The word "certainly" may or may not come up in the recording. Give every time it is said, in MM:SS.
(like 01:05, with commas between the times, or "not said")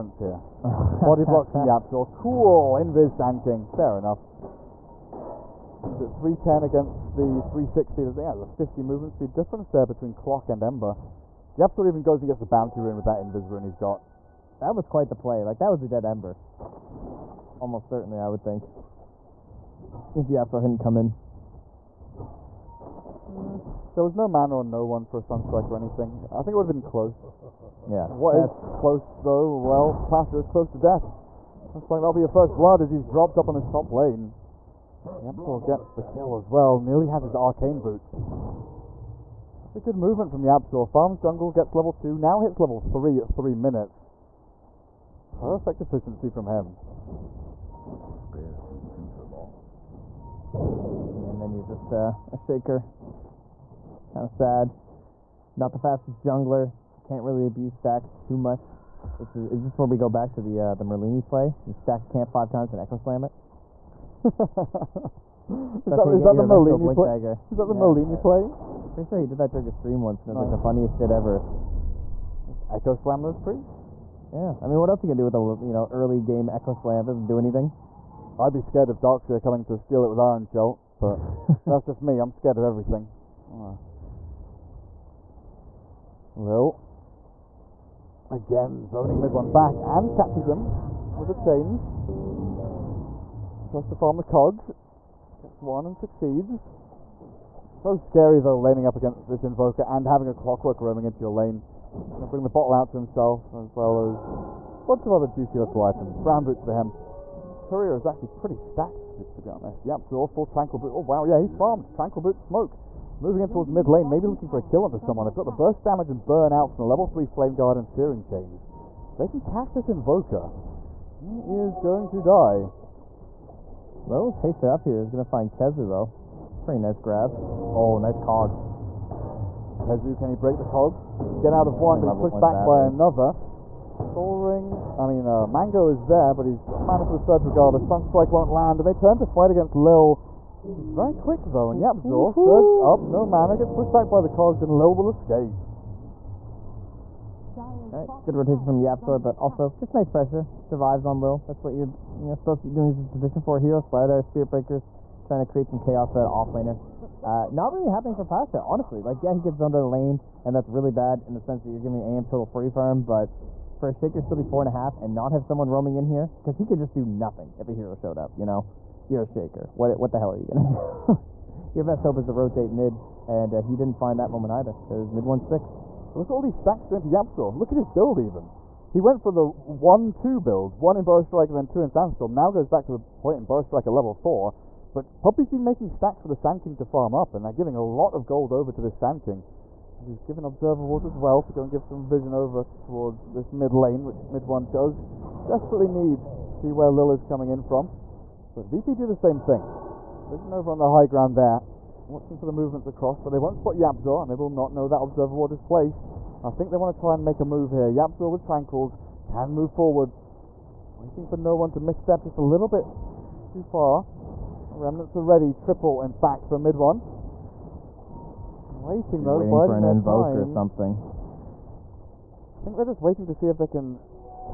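00:17.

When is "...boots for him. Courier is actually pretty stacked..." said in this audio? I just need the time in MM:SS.
01:46.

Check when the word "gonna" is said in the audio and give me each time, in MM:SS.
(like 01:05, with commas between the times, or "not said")
01:15, 01:42.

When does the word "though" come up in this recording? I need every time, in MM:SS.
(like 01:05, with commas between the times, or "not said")
00:29, 01:38, 02:05, 02:21, 03:39.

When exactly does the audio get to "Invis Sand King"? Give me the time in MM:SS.
00:02.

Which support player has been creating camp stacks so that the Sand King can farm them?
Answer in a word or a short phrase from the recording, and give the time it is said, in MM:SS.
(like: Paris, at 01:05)
Puppey, at 03:05.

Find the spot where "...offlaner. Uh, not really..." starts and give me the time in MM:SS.
02:36.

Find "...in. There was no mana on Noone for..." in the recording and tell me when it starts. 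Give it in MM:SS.
00:20.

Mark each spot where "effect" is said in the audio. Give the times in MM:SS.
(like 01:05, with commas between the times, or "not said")
not said.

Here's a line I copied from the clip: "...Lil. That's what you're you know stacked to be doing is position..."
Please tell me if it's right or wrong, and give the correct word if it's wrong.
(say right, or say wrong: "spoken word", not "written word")
wrong: "supposed", not "stacked".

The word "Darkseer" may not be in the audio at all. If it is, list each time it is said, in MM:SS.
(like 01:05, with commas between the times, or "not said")
01:19.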